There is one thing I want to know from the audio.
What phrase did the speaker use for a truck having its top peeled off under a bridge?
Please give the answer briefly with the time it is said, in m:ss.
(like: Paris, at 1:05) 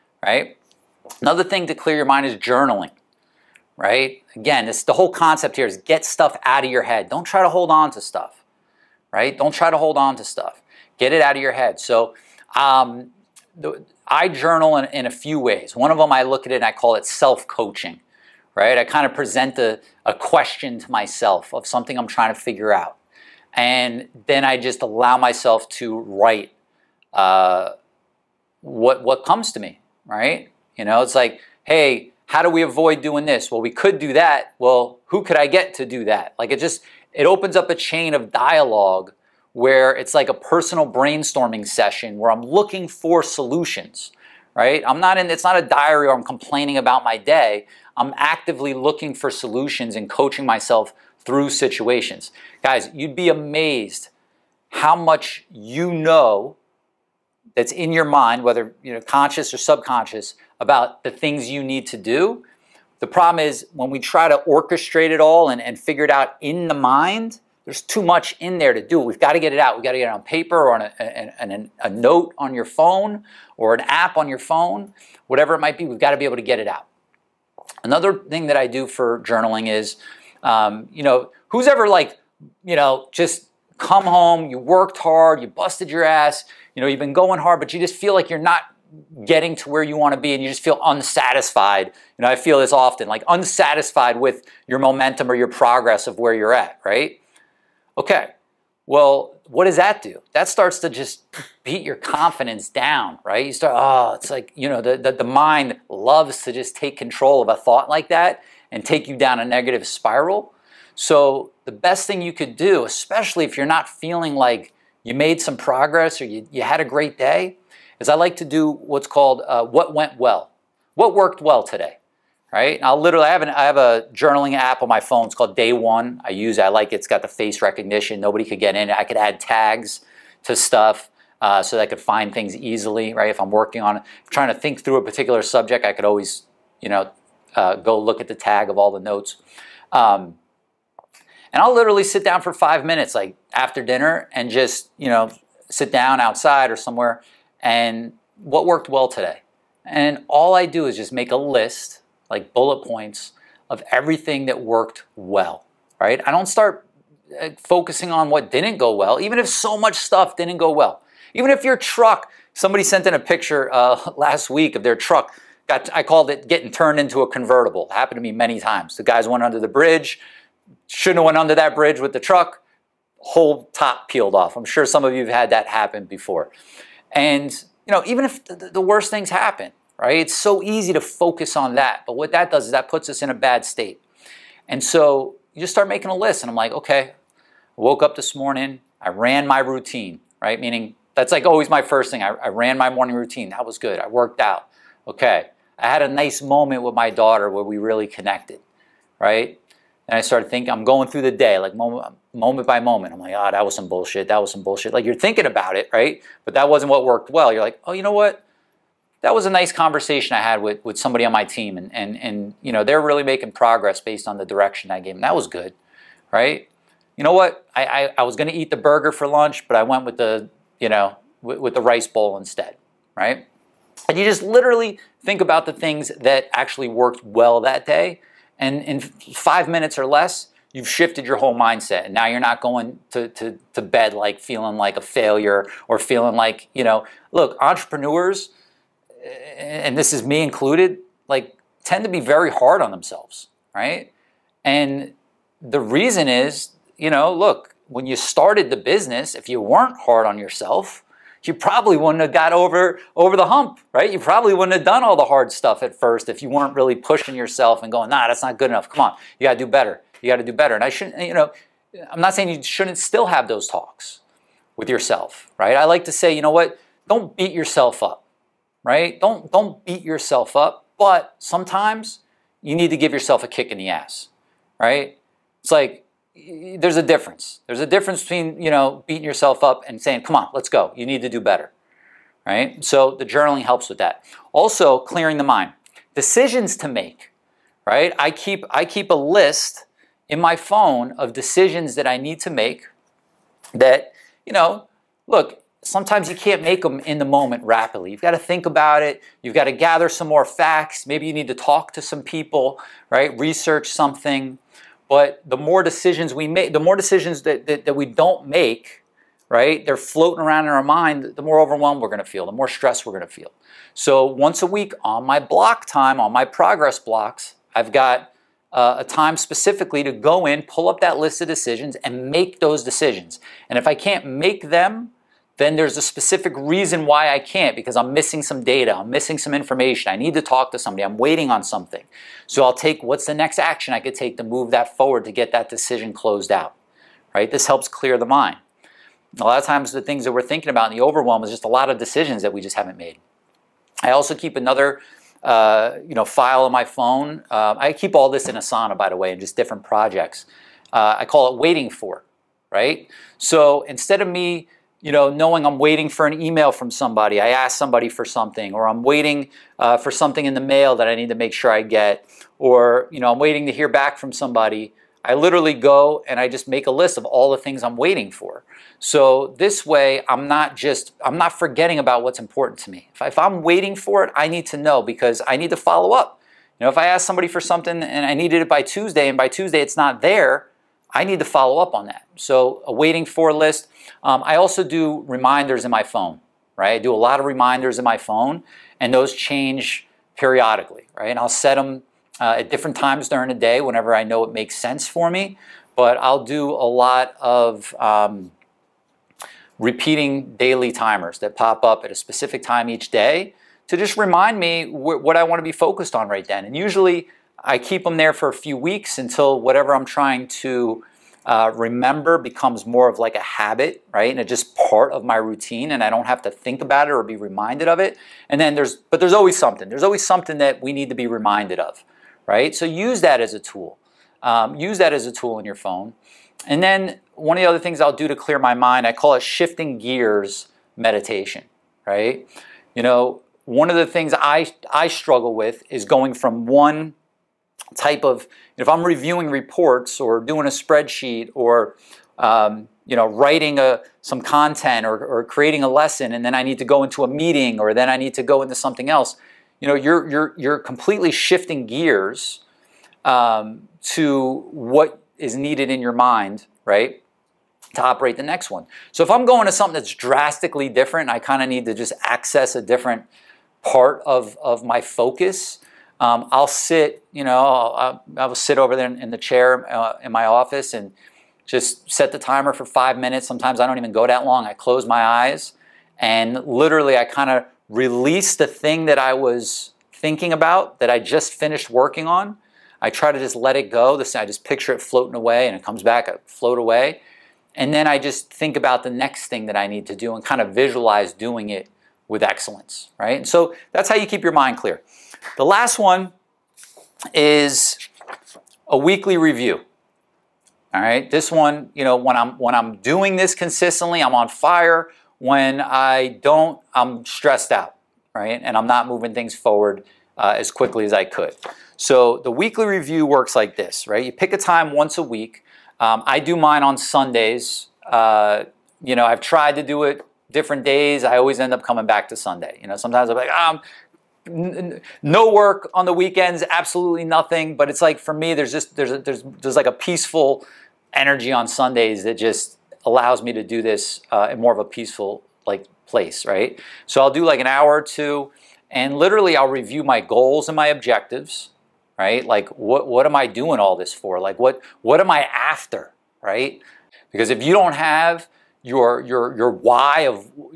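getting turned into a convertible, at 2:46.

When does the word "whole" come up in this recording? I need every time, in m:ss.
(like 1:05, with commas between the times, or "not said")
0:04, 2:53, 3:51.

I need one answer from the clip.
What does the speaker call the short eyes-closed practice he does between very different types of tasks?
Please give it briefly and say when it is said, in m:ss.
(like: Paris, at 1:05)
shifting gears meditation, at 7:09.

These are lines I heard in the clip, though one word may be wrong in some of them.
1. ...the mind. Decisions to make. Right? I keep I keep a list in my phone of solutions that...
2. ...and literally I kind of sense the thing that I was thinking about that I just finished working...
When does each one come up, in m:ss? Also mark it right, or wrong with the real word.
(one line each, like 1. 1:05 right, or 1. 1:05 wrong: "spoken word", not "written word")
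1. 4:45 wrong: "decisions", not "solutions"
2. 7:56 wrong: "release", not "sense".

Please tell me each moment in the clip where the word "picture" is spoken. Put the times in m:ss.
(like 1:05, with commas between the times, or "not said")
2:43, 8:04.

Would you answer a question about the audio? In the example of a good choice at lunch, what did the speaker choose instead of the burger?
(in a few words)
rice bowl.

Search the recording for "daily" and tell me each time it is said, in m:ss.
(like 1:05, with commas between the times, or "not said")
6:40.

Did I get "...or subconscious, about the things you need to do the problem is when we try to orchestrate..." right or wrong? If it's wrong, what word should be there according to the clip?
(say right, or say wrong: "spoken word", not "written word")
right.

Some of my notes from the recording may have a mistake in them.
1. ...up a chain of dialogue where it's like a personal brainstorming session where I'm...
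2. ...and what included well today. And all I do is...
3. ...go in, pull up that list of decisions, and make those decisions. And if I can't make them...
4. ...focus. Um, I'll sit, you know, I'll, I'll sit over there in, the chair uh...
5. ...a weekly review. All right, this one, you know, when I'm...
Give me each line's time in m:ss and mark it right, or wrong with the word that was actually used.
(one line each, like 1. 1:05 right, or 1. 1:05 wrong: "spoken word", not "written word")
1. 0:37 right
2. 2:27 wrong: "worked", not "included"
3. 5:20 right
4. 7:45 right
5. 8:18 right.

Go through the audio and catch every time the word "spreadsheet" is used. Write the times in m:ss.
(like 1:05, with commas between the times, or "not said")
7:20.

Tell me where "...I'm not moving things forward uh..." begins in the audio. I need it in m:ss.
8:28.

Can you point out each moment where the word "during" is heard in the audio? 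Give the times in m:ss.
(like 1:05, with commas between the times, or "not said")
6:33.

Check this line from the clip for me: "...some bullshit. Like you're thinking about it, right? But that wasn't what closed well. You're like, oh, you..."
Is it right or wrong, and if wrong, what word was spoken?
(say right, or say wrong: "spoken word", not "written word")
wrong: "worked", not "closed".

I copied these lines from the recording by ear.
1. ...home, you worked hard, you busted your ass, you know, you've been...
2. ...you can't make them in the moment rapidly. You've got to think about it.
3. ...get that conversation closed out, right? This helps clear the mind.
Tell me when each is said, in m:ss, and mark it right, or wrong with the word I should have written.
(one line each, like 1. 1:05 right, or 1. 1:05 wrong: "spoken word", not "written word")
1. 1:24 right
2. 4:56 right
3. 5:35 wrong: "decision", not "conversation".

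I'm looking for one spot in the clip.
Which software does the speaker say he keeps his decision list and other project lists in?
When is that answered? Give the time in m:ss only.
5:48.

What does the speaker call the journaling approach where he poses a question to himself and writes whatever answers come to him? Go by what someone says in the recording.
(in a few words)
self-coaching.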